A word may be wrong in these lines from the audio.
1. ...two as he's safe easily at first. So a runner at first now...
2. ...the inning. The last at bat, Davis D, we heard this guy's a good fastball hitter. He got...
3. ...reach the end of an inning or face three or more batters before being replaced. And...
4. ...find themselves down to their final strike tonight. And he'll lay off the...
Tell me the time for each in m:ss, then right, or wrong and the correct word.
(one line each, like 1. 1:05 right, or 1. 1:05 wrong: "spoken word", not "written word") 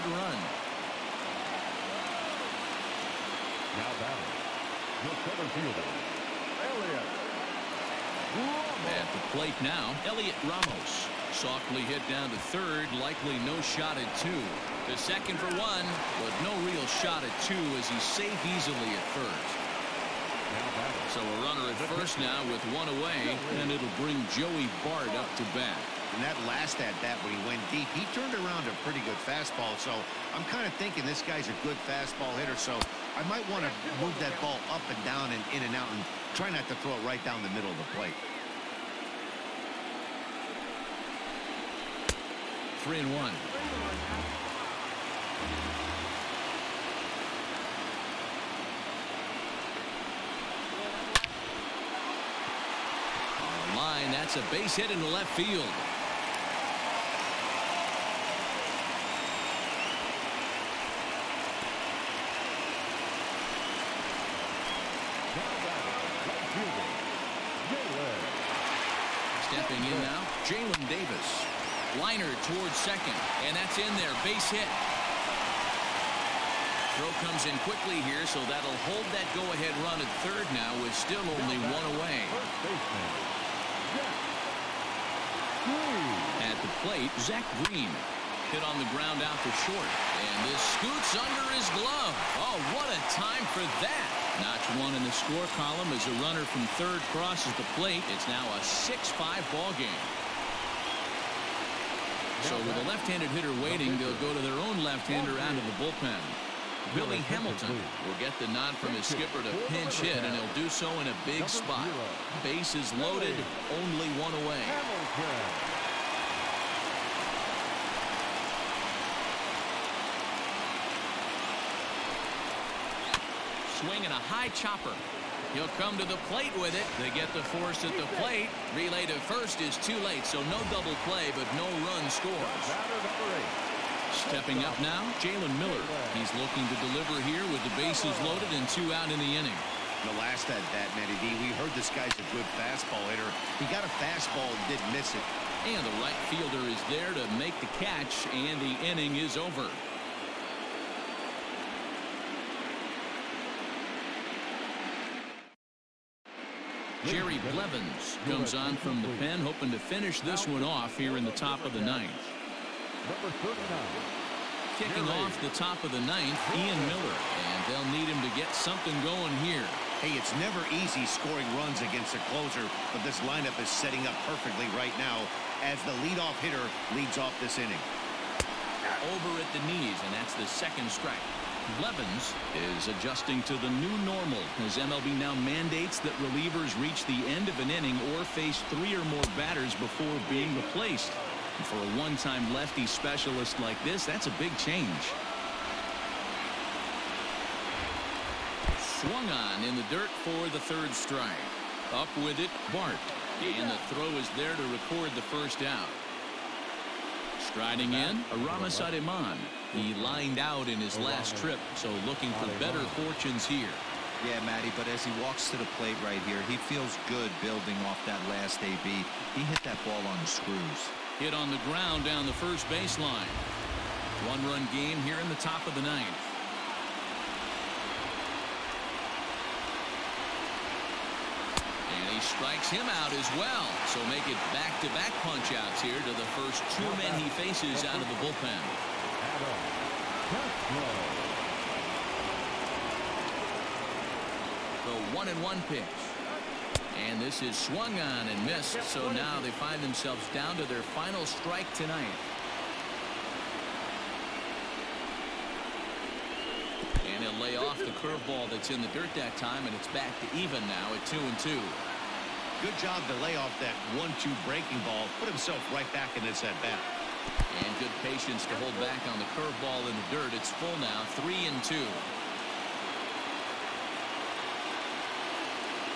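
1. 0:17 right
2. 2:19 wrong: "Matty", not "Davis"
3. 3:06 right
4. 4:09 right.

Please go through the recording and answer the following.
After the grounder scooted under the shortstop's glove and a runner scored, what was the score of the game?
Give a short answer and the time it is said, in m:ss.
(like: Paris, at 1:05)
6-5, at 1:38.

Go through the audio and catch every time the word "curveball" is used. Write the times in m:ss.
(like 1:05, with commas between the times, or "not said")
4:18, 4:29.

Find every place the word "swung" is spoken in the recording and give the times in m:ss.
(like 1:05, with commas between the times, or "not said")
3:19, 4:07.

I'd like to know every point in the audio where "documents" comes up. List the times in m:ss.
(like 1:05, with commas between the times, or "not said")
not said.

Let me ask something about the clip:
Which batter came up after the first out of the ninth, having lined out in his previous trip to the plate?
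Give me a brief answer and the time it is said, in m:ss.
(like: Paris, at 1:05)
Aramis Ademan, at 3:28.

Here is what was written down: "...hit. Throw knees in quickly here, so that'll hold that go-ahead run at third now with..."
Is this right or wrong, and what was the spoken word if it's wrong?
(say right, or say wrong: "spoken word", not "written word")
wrong: "comes", not "knees".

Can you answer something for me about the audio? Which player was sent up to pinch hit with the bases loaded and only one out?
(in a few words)
Billy Hamilton.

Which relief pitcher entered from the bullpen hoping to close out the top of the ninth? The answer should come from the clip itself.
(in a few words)
Jerry Blevins.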